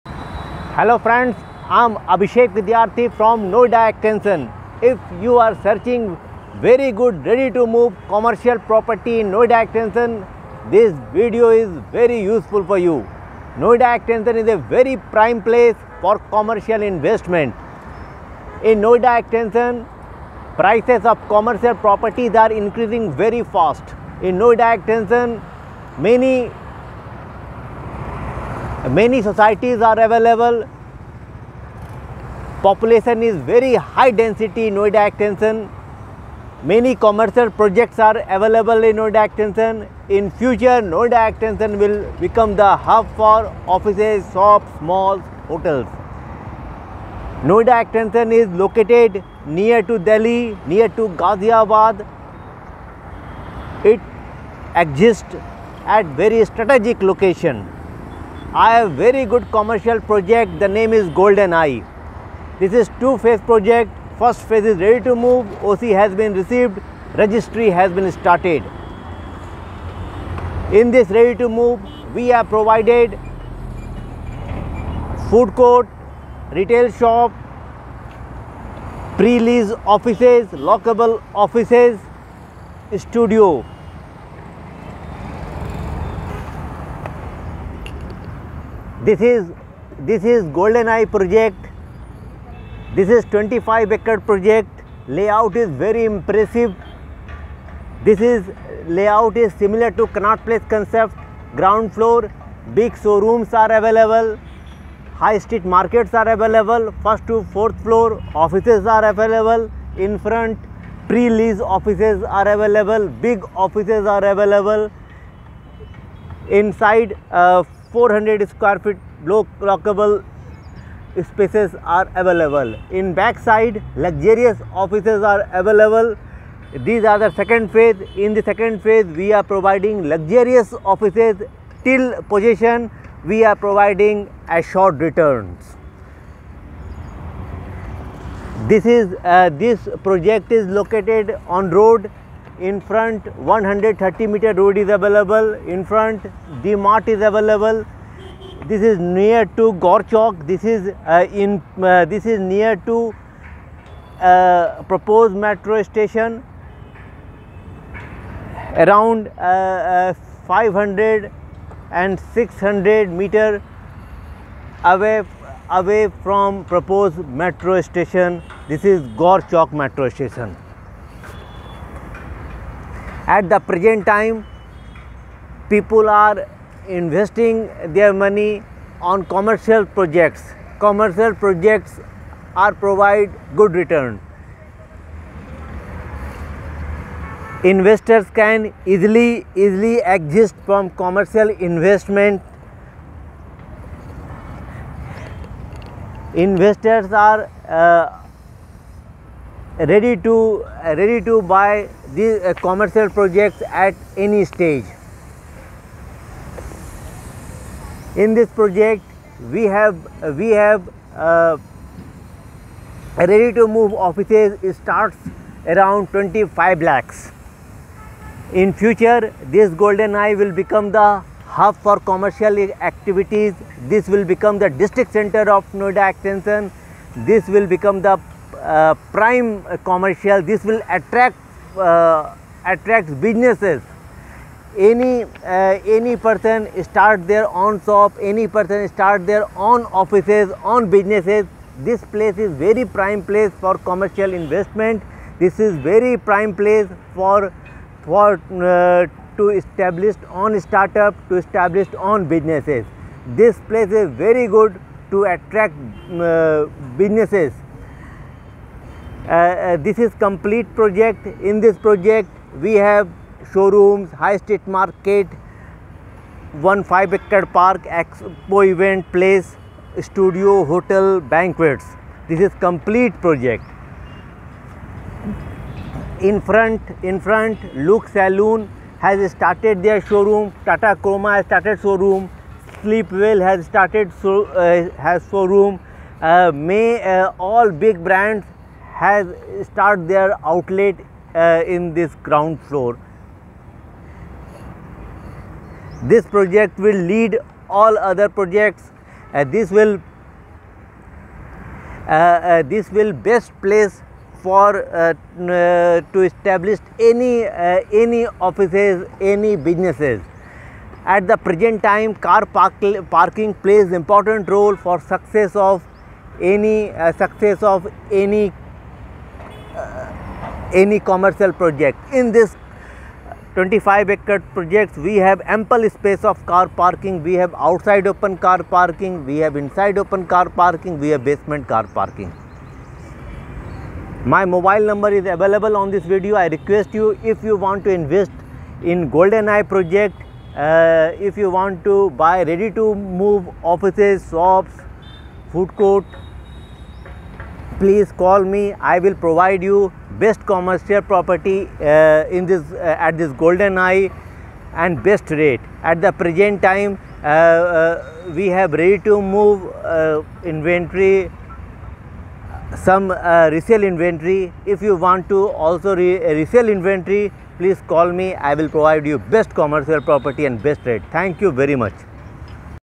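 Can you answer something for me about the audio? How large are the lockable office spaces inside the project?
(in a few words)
400 square feet.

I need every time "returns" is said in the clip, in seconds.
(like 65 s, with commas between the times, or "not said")
134 s, 183 s.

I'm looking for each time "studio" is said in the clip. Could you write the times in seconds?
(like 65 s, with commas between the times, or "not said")
82 s, 270 s.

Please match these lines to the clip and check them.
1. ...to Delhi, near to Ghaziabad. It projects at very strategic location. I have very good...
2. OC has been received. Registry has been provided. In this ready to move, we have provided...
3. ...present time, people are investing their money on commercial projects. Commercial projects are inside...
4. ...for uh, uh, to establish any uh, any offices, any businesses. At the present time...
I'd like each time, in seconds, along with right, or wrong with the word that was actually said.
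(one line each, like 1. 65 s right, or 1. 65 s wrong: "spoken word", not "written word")
1. 49 s wrong: "exists", not "projects"
2. 65 s wrong: "started", not "provided"
3. 173 s wrong: "provide", not "inside"
4. 304 s right.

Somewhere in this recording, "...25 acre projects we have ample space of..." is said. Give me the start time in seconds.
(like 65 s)
323 s.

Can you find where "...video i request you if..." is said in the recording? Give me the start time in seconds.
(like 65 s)
336 s.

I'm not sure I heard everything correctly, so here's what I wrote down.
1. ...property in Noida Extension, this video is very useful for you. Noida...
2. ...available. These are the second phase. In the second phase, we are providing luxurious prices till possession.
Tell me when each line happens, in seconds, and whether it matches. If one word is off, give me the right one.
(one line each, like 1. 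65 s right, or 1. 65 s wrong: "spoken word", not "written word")
1. 8 s right
2. 125 s wrong: "offices", not "prices".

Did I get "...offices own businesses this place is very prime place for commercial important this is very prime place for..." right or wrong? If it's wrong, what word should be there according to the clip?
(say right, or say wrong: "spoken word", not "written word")
wrong: "investment", not "important".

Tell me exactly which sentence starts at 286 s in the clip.
Uh, May uh, all big brands has start their outlet uh, in this ground floor.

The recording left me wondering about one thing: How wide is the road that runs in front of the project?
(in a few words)
130 meter.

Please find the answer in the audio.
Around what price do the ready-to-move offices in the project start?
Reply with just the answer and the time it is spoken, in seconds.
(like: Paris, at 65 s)
25 lakhs, at 216 s.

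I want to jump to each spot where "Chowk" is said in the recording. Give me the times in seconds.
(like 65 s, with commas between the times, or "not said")
150 s, 169 s.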